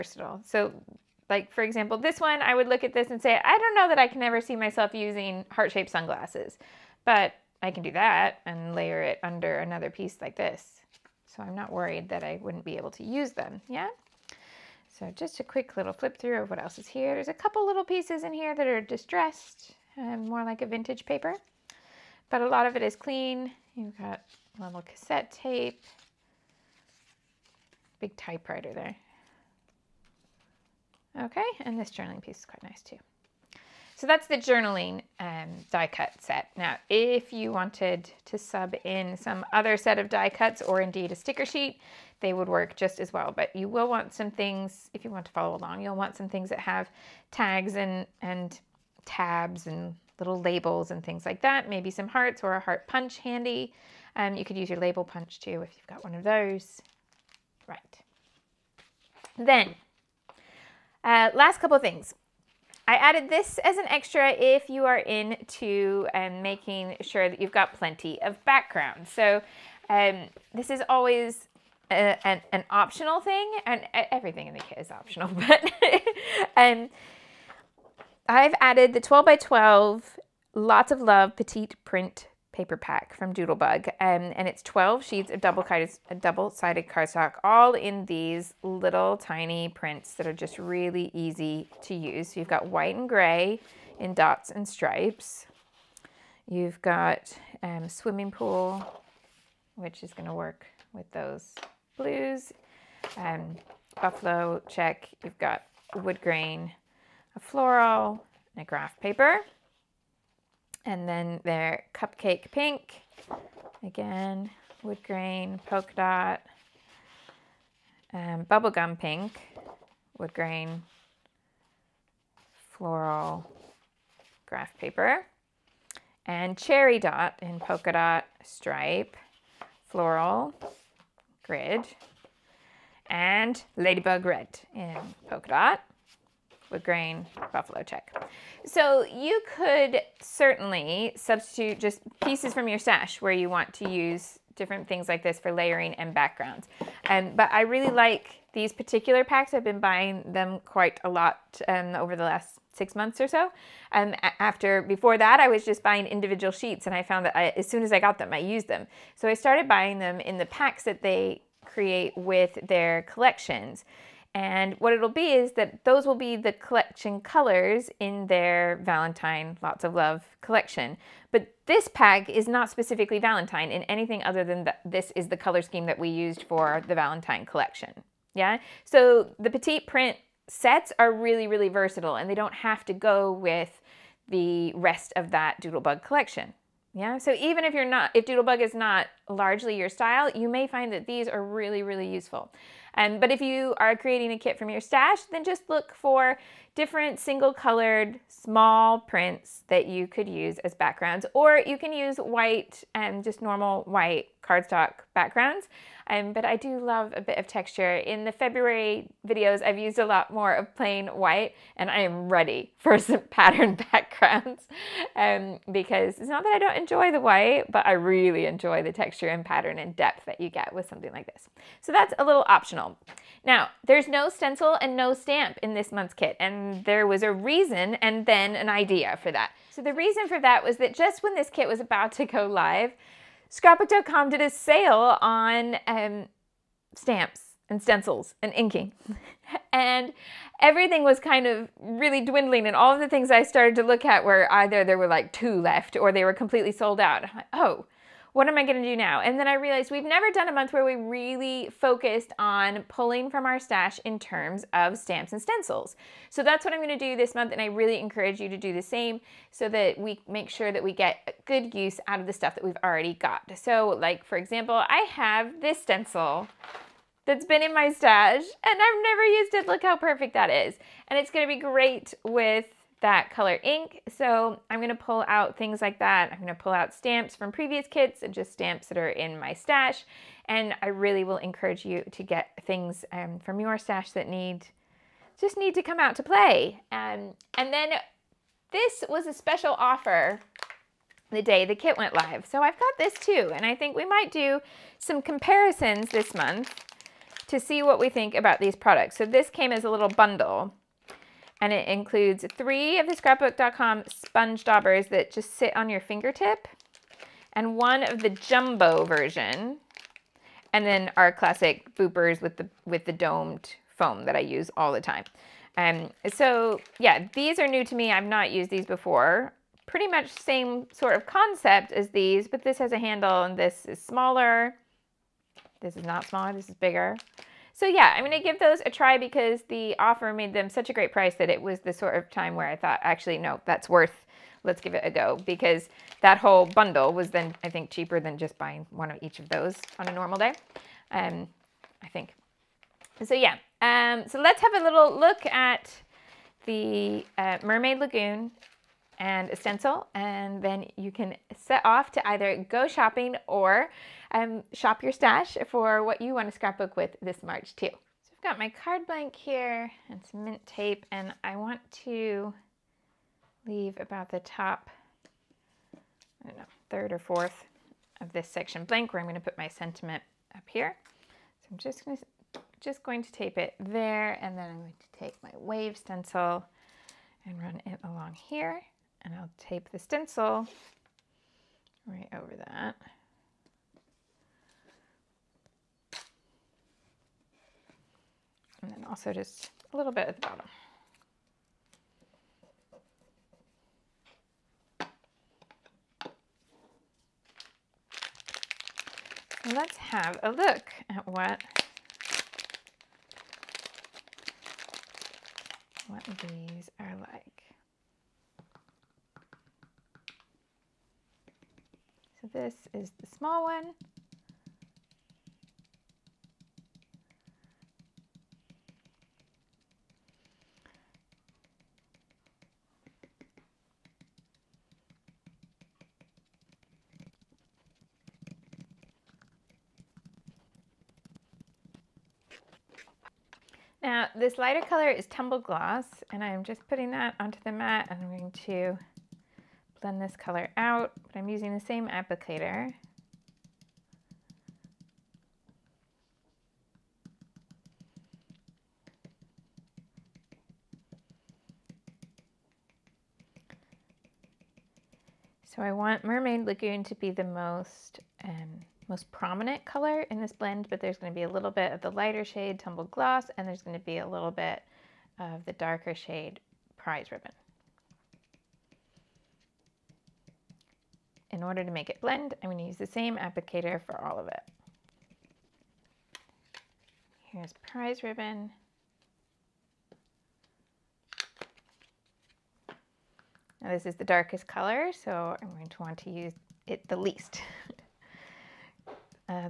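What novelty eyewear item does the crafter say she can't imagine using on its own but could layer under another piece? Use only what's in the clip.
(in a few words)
heart-shaped sunglasses.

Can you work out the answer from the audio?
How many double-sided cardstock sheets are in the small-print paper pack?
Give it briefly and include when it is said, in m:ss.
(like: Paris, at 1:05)
12, at 1:24.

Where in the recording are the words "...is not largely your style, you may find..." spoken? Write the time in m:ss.
3:08.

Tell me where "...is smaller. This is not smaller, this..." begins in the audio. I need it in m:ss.
5:23.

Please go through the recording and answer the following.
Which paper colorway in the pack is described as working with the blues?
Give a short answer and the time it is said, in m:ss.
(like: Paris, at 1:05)
swimming pool, at 1:37.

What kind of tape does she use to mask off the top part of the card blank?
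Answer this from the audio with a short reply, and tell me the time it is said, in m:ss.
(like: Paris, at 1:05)
mint tape, at 6:00.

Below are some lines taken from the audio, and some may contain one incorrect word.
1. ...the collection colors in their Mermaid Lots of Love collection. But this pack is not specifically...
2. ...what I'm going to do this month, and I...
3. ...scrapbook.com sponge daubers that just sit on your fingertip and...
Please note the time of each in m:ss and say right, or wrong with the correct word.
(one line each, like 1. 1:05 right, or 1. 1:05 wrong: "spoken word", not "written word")
1. 2:46 wrong: "Valentine", not "Mermaid"
2. 4:16 right
3. 5:03 right.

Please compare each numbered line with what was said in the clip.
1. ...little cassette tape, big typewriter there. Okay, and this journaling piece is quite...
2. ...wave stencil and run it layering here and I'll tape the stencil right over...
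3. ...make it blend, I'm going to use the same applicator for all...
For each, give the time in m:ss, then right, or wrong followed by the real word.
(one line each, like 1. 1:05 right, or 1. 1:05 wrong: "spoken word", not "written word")
1. 0:24 right
2. 6:15 wrong: "along", not "layering"
3. 7:51 right.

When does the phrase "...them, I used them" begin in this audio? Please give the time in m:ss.
2:38.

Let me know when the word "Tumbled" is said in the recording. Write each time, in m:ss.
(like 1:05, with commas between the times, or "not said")
7:15, 7:42.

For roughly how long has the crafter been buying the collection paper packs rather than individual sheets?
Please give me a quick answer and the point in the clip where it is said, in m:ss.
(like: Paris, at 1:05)
six months, at 2:32.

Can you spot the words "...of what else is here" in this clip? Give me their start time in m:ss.
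0:16.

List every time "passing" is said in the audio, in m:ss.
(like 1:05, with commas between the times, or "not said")
not said.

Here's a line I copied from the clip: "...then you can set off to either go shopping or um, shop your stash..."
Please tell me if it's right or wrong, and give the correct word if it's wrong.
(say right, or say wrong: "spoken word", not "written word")
right.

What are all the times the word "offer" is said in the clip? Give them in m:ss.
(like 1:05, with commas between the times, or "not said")
4:49, 5:29.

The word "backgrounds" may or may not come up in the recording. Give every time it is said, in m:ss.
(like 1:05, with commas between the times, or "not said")
1:08, 2:26, 3:20, 3:25, 3:33.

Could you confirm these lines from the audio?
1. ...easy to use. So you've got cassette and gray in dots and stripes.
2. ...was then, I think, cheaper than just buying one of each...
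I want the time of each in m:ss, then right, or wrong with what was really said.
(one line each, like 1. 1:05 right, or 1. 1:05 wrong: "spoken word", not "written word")
1. 1:31 wrong: "white", not "cassette"
2. 5:37 right.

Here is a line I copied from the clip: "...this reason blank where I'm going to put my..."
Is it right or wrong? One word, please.
wrong.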